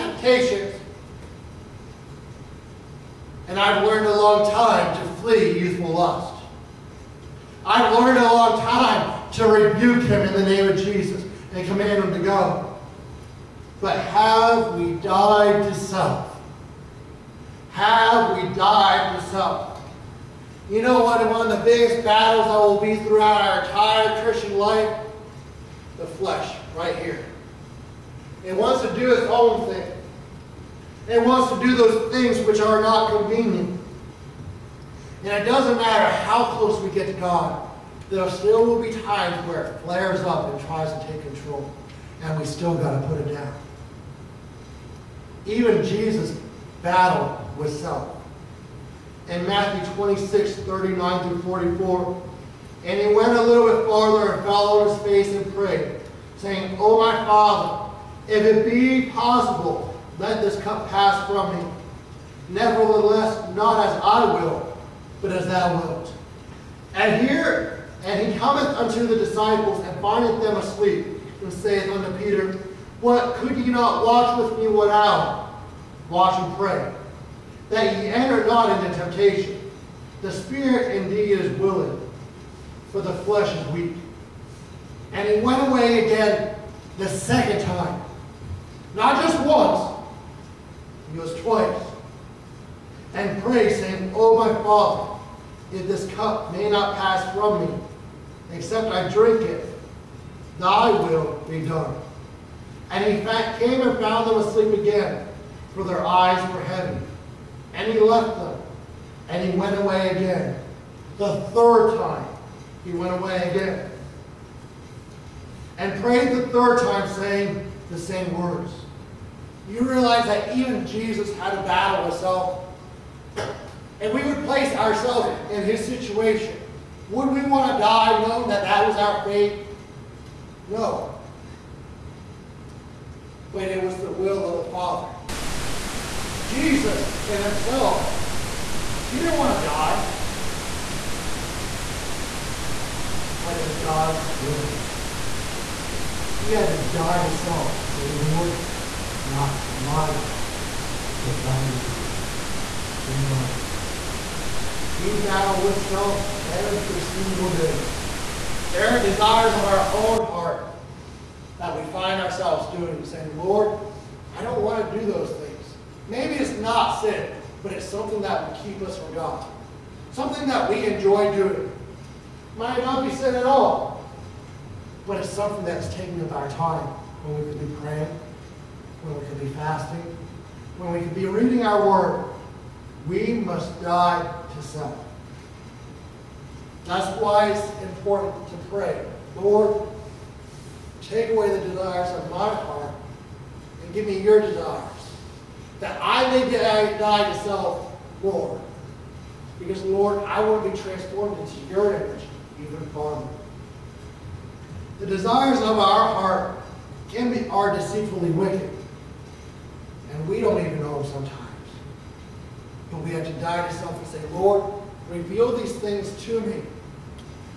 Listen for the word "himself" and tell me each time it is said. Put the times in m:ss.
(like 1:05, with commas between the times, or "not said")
2:02, 2:17.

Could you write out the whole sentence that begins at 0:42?
And we still got to put it down.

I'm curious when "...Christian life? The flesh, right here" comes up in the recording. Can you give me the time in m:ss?
0:24.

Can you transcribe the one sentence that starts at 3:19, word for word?
Because, Lord, I want to be transformed into your image even more.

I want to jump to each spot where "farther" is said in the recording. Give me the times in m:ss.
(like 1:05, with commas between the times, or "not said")
0:53.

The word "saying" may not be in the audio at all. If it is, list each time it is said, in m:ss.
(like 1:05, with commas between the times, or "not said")
0:56, 1:33, 1:57, 2:43.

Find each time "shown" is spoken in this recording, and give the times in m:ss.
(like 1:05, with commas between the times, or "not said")
not said.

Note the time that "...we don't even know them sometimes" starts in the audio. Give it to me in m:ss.
3:30.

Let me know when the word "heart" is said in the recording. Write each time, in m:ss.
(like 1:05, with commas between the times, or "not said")
2:40, 3:12, 3:26.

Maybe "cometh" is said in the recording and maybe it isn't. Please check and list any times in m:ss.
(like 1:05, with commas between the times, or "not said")
1:08.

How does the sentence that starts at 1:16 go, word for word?
Watch and pray, that ye enter not into temptation.